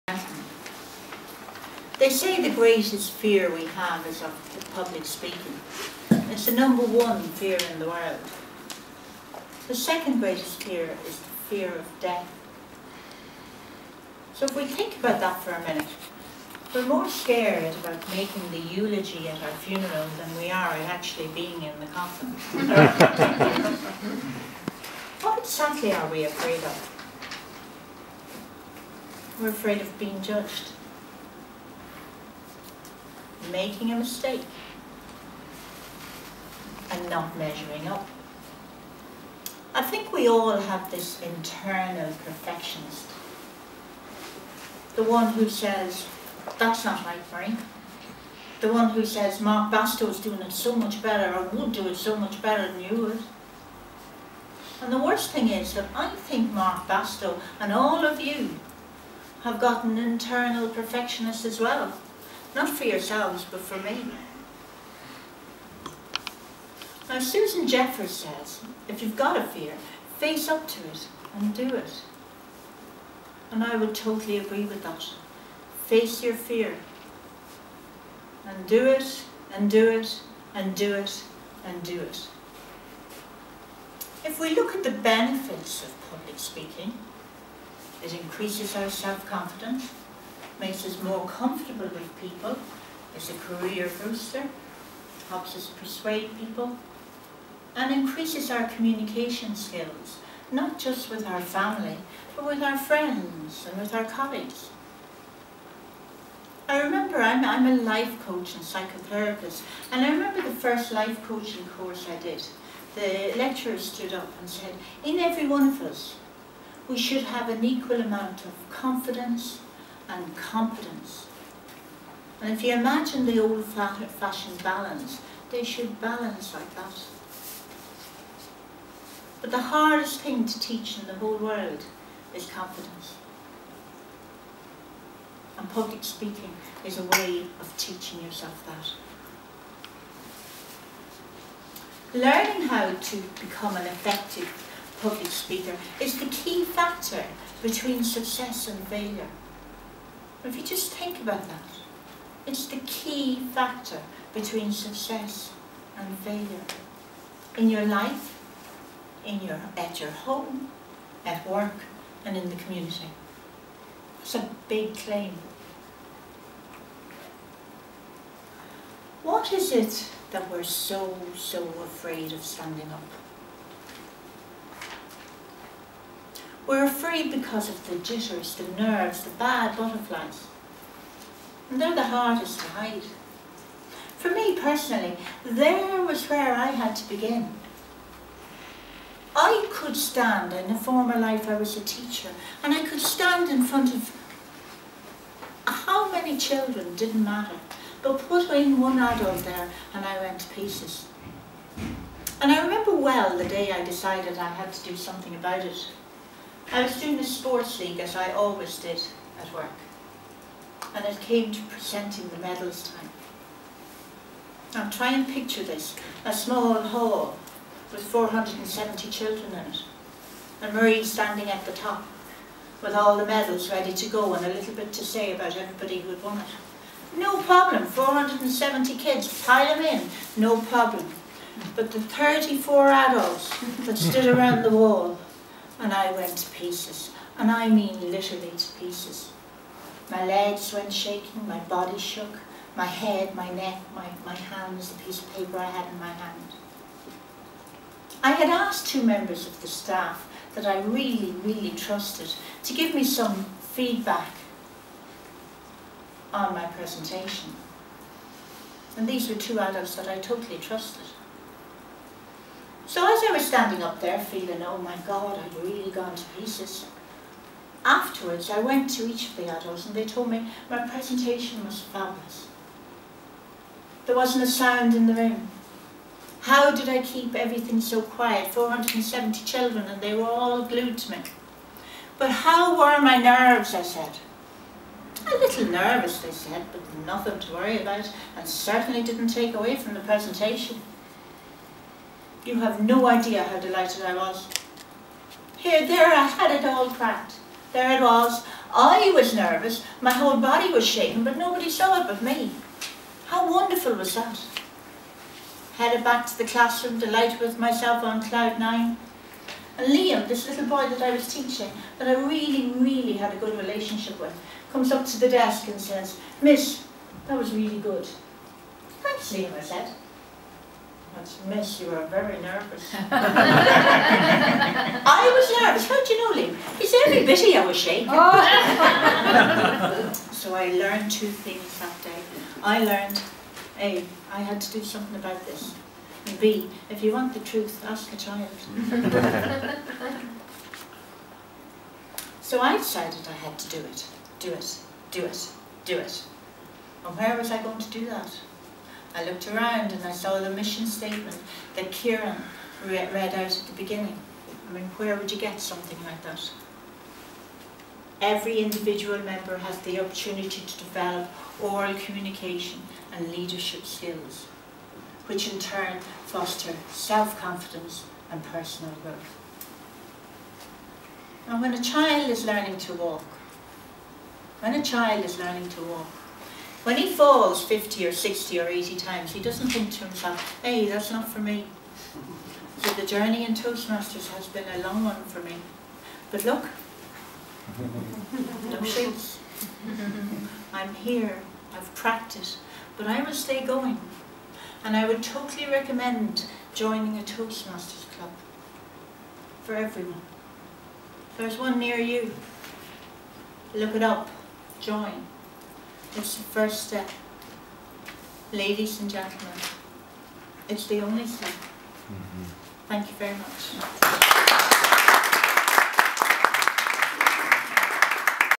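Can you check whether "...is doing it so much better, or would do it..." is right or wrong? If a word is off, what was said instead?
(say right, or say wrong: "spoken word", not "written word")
right.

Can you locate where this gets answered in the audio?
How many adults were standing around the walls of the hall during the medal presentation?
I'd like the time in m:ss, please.
3:51.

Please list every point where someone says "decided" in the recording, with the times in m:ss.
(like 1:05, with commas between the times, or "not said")
3:23, 5:42.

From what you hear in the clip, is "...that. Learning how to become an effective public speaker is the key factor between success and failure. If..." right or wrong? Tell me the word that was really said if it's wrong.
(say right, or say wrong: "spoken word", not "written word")
right.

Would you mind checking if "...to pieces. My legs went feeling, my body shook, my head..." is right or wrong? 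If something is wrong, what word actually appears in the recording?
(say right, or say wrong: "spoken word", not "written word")
wrong: "shaking", not "feeling".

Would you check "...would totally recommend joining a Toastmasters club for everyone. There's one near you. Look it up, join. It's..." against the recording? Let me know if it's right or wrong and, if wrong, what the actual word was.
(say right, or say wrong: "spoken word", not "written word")
right.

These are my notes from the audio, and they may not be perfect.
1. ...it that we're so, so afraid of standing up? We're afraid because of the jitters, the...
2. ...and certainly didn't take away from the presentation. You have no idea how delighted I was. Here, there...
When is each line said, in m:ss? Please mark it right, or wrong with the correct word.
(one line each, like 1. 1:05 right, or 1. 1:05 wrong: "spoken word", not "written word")
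1. 2:49 right
2. 4:48 right.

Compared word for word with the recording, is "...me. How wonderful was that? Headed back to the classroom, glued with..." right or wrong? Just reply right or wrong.
wrong.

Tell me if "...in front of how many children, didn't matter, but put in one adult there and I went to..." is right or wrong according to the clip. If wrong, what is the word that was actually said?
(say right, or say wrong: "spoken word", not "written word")
right.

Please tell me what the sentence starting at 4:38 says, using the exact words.
470 children and they were all glued to me.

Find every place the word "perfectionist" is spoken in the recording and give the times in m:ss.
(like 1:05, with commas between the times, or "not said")
0:42, 1:00.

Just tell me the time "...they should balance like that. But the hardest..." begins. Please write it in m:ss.
2:05.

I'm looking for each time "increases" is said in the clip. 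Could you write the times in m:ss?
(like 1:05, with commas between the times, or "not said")
1:28, 1:37.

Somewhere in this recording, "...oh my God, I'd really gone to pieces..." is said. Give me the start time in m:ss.
4:24.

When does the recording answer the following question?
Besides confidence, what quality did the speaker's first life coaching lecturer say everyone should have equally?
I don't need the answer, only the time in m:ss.
2:00.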